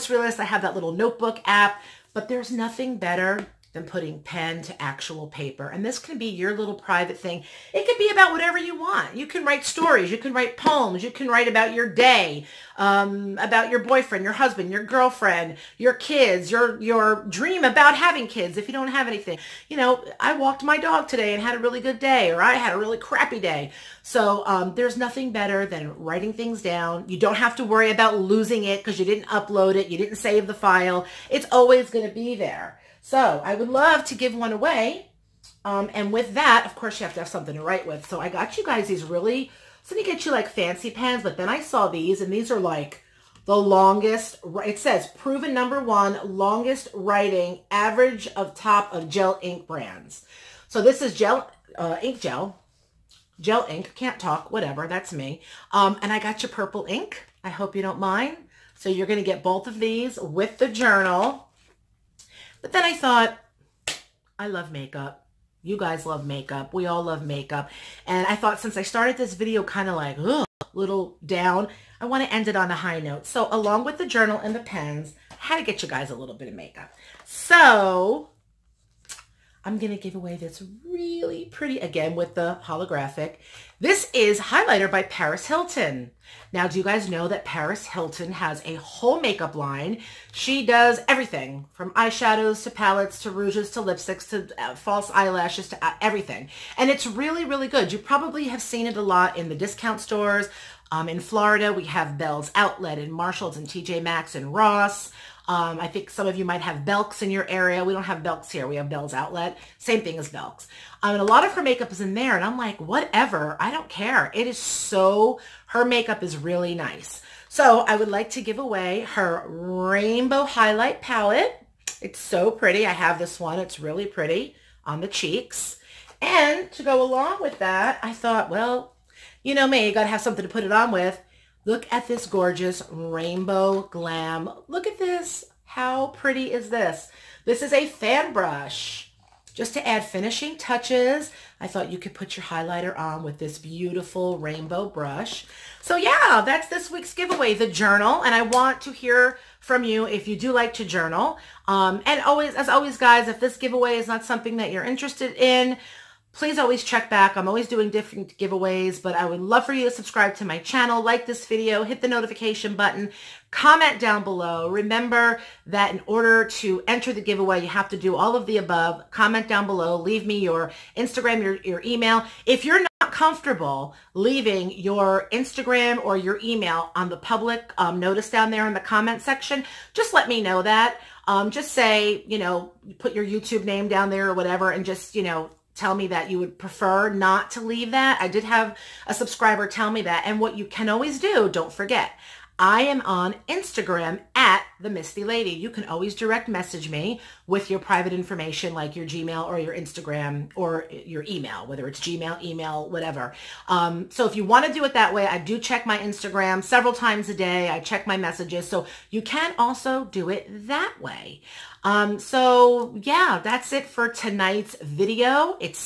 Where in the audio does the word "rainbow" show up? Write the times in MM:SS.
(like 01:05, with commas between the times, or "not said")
01:59, 02:12, 02:24.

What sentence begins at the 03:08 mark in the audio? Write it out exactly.
I did have a subscriber tell me that.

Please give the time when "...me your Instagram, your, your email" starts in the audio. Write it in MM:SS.
02:50.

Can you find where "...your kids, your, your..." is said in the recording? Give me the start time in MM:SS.
00:15.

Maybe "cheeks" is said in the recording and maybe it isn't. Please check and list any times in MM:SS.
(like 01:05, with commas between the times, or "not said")
02:05.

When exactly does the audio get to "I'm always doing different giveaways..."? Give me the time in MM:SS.
02:37.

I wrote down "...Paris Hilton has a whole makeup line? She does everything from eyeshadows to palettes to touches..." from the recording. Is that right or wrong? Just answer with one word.
wrong.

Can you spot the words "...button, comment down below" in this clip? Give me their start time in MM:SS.
02:42.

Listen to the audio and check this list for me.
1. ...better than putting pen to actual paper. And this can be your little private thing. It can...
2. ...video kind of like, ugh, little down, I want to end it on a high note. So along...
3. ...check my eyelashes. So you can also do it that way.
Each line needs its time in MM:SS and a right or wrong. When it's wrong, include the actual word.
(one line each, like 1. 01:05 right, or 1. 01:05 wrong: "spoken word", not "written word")
1. 00:02 right
2. 01:09 right
3. 03:27 wrong: "messages", not "eyelashes".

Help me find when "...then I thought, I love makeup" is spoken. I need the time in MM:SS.
01:02.